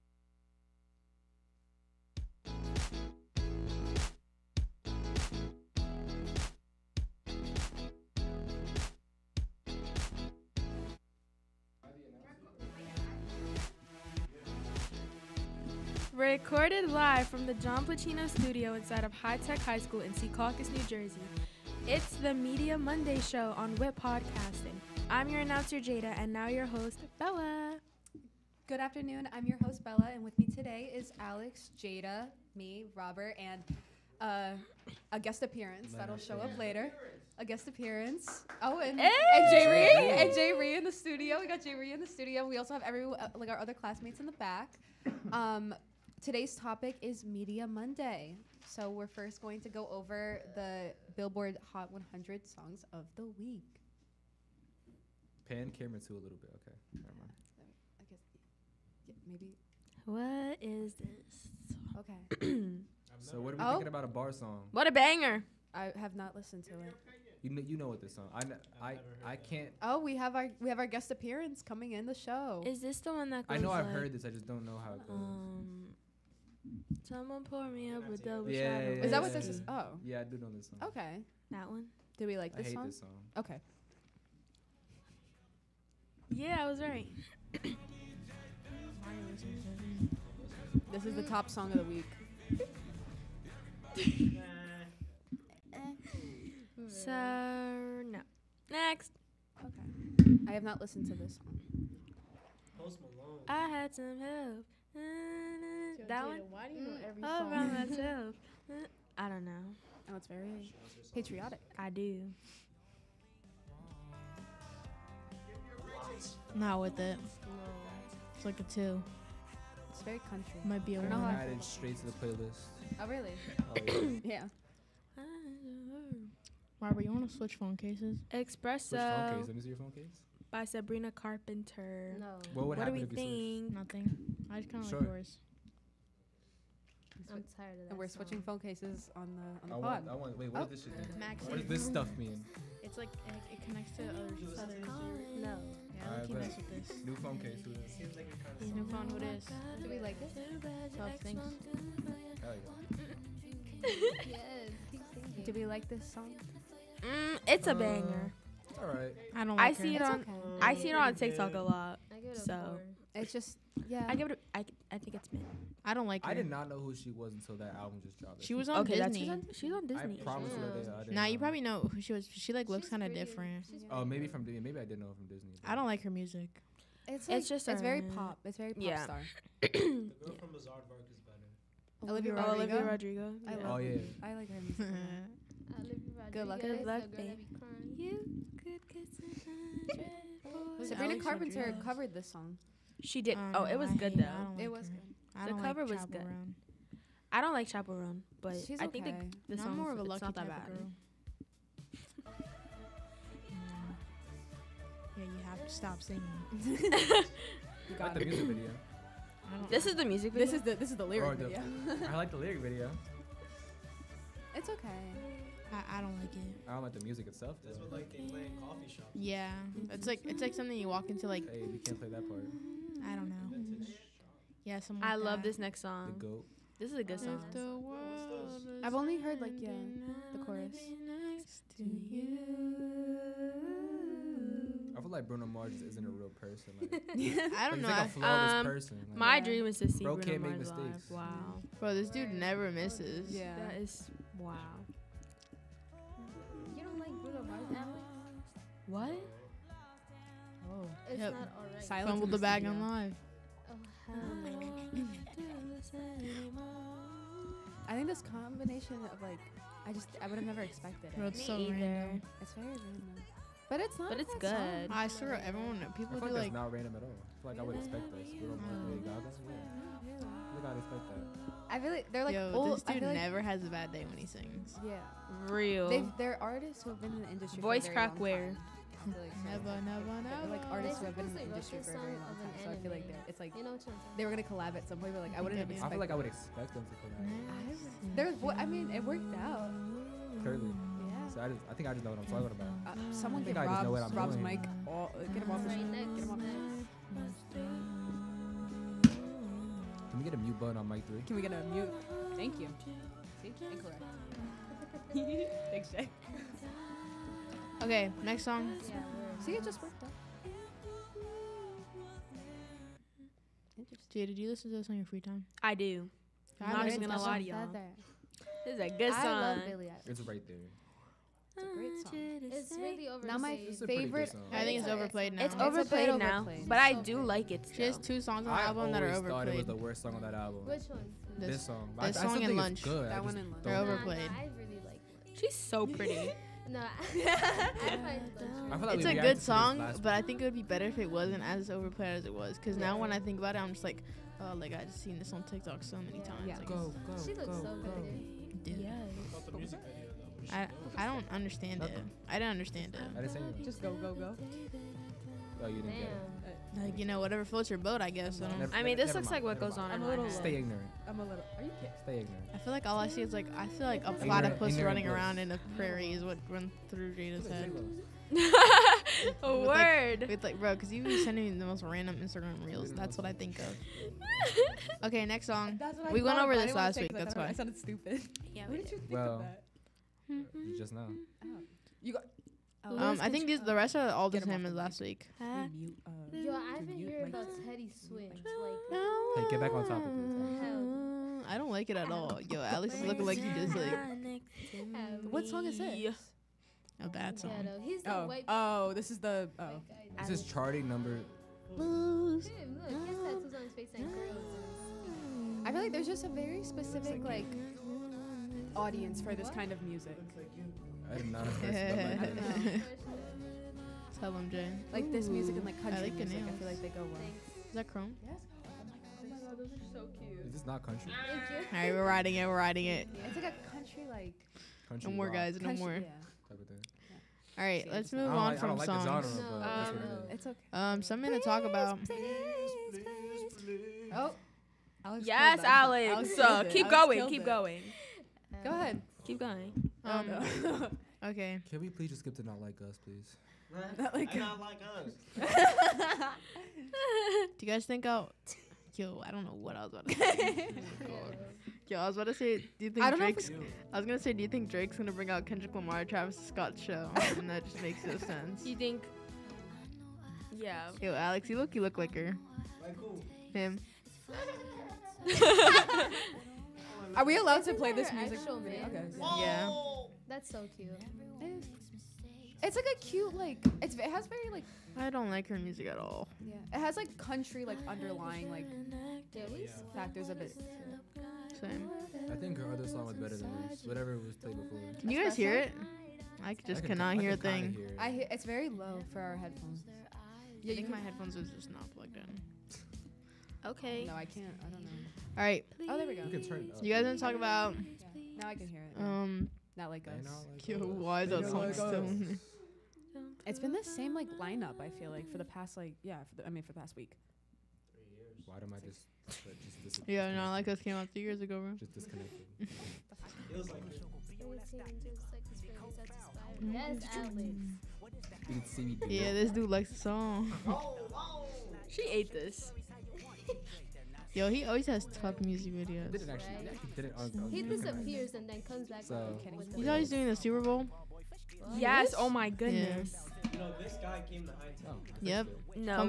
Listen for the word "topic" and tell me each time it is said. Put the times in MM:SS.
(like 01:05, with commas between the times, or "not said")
00:46, 06:29.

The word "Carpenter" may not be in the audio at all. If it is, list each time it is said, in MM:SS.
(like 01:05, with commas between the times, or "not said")
02:11, 03:11.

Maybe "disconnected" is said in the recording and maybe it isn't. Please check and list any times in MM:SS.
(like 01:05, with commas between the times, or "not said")
08:31.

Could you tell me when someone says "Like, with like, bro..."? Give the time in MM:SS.
06:10.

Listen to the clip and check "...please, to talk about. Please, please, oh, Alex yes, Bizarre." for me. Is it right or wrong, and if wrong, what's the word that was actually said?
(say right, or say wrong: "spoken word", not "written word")
wrong: "Alex", not "Bizarre".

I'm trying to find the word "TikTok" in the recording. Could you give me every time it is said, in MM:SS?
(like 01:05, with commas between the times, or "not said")
02:41, 05:45.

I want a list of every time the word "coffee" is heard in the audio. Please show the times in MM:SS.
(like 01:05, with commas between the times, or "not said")
03:38.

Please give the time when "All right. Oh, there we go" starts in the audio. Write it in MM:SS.
08:15.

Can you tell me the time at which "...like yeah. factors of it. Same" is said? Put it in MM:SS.
07:58.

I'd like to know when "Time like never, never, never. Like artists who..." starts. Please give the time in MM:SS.
04:38.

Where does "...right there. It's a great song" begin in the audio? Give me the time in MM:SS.
05:20.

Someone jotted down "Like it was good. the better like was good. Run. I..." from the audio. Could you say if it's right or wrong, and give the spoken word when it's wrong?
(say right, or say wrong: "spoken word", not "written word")
wrong: "cover", not "better".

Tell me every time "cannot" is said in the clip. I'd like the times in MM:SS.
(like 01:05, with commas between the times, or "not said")
08:06.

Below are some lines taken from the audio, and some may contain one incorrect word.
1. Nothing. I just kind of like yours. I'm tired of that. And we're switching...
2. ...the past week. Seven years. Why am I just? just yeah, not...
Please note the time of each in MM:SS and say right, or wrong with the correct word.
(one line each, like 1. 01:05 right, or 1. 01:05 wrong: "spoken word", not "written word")
1. 02:13 right
2. 08:26 wrong: "Three", not "Seven".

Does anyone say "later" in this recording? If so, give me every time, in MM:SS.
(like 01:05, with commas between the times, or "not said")
00:36.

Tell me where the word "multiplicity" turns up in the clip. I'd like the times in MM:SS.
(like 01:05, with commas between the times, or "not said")
not said.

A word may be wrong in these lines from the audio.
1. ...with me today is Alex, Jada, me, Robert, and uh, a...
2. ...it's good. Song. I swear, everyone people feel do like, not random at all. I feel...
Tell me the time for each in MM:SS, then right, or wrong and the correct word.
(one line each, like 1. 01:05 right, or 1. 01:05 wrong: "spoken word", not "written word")
1. 00:30 right
2. 04:24 right.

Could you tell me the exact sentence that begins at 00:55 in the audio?
Pan camera too a little bit.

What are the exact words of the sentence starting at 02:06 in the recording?
Robert, you want to switch phone cases?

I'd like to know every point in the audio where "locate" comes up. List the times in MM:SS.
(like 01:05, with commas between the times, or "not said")
not said.